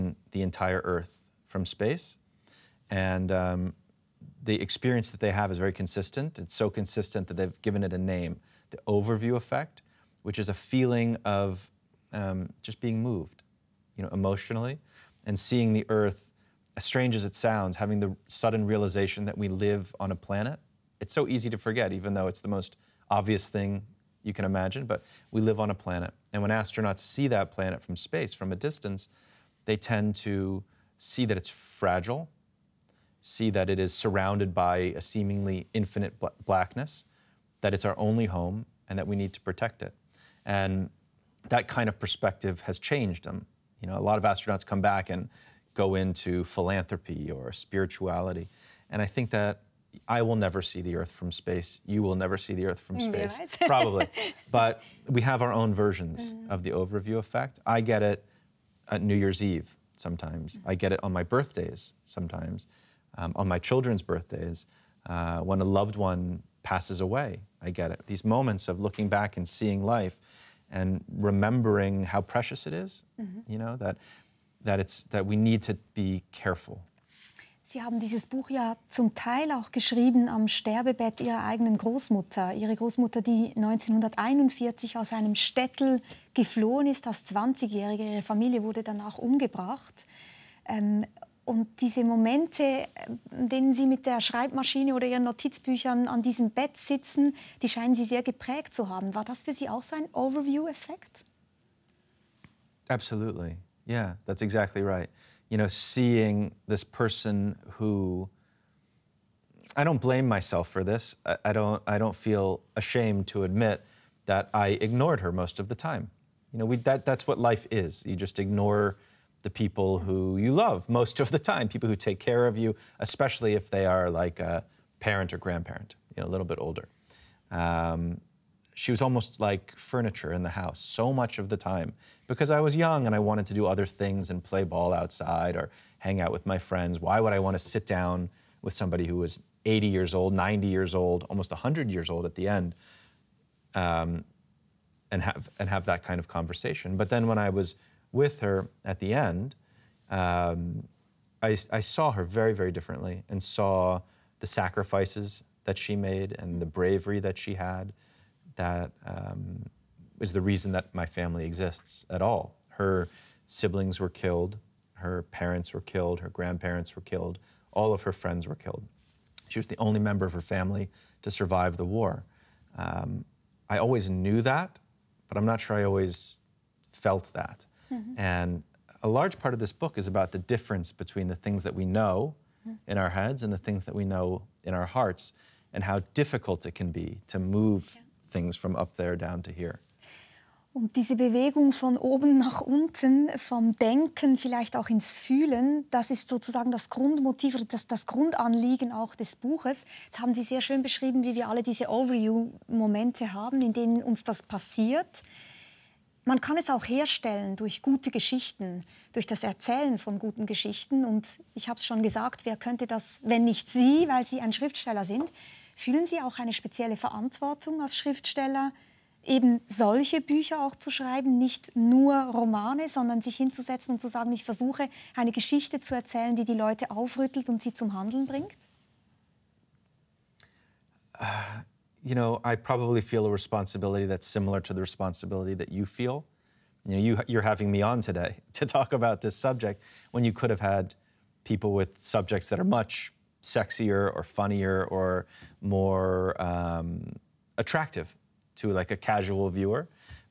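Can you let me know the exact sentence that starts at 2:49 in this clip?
She was the only member of her family to survive the war.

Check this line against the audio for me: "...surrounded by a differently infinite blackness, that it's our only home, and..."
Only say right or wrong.
wrong.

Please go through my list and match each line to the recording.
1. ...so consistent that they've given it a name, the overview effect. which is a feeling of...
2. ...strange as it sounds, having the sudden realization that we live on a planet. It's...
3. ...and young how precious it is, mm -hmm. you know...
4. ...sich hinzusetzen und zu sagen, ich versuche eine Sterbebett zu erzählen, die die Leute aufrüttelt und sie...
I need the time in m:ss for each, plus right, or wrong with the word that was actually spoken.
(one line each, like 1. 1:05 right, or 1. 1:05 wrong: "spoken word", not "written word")
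1. 0:06 right
2. 0:16 right
3. 1:10 wrong: "remembering", not "young"
4. 3:43 wrong: "Geschichte", not "Sterbebett".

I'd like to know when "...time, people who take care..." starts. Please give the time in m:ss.
2:01.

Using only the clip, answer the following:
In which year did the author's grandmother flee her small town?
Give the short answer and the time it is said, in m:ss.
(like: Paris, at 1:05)
1941, at 1:23.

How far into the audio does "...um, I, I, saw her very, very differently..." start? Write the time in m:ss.
2:30.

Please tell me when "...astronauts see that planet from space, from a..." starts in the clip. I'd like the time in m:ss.
0:26.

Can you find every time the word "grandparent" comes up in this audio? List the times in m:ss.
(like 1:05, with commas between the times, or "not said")
2:05, 2:46.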